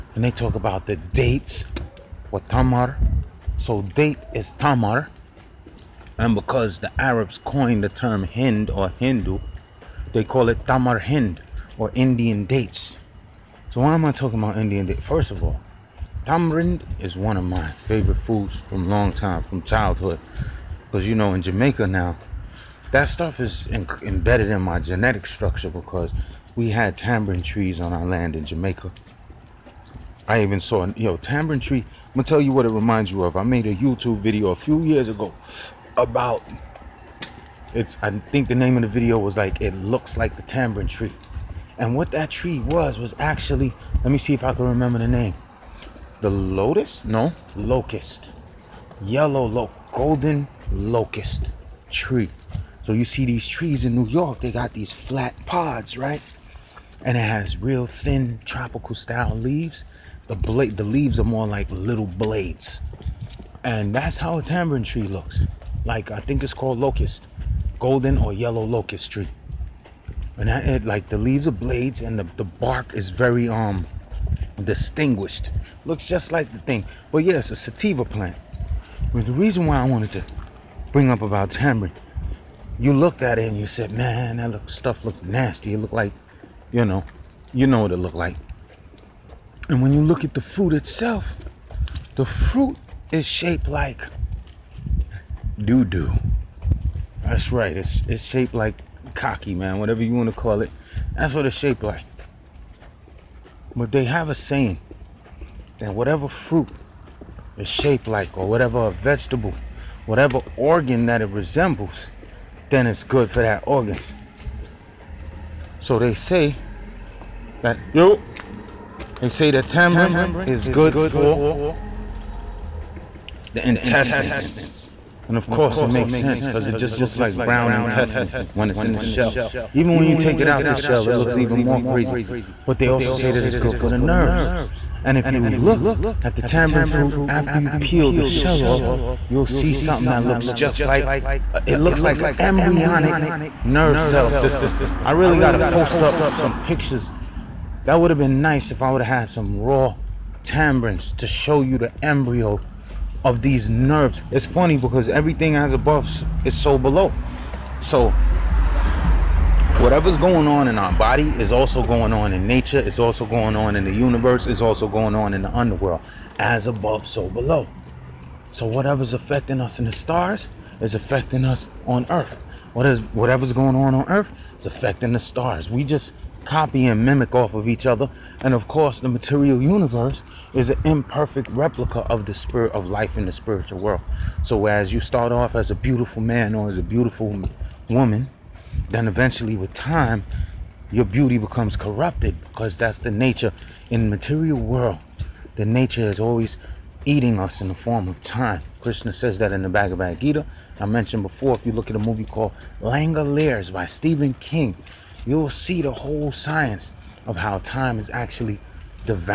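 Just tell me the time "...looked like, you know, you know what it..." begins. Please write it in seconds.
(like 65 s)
85 s.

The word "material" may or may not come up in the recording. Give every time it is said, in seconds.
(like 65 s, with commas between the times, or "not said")
179 s, 194 s.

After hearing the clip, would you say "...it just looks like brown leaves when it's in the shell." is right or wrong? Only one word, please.
wrong.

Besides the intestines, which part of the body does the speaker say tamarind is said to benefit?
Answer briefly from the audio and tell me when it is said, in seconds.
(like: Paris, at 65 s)
the nerves, at 133 s.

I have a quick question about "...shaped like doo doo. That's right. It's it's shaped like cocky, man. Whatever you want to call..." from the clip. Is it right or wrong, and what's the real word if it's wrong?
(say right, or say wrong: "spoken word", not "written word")
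right.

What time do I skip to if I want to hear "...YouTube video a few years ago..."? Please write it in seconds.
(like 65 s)
33 s.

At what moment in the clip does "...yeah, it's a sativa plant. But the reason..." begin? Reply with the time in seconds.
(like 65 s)
77 s.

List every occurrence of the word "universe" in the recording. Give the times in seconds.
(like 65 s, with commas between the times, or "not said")
163 s, 179 s.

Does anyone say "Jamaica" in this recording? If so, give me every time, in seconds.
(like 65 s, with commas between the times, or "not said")
21 s, 28 s.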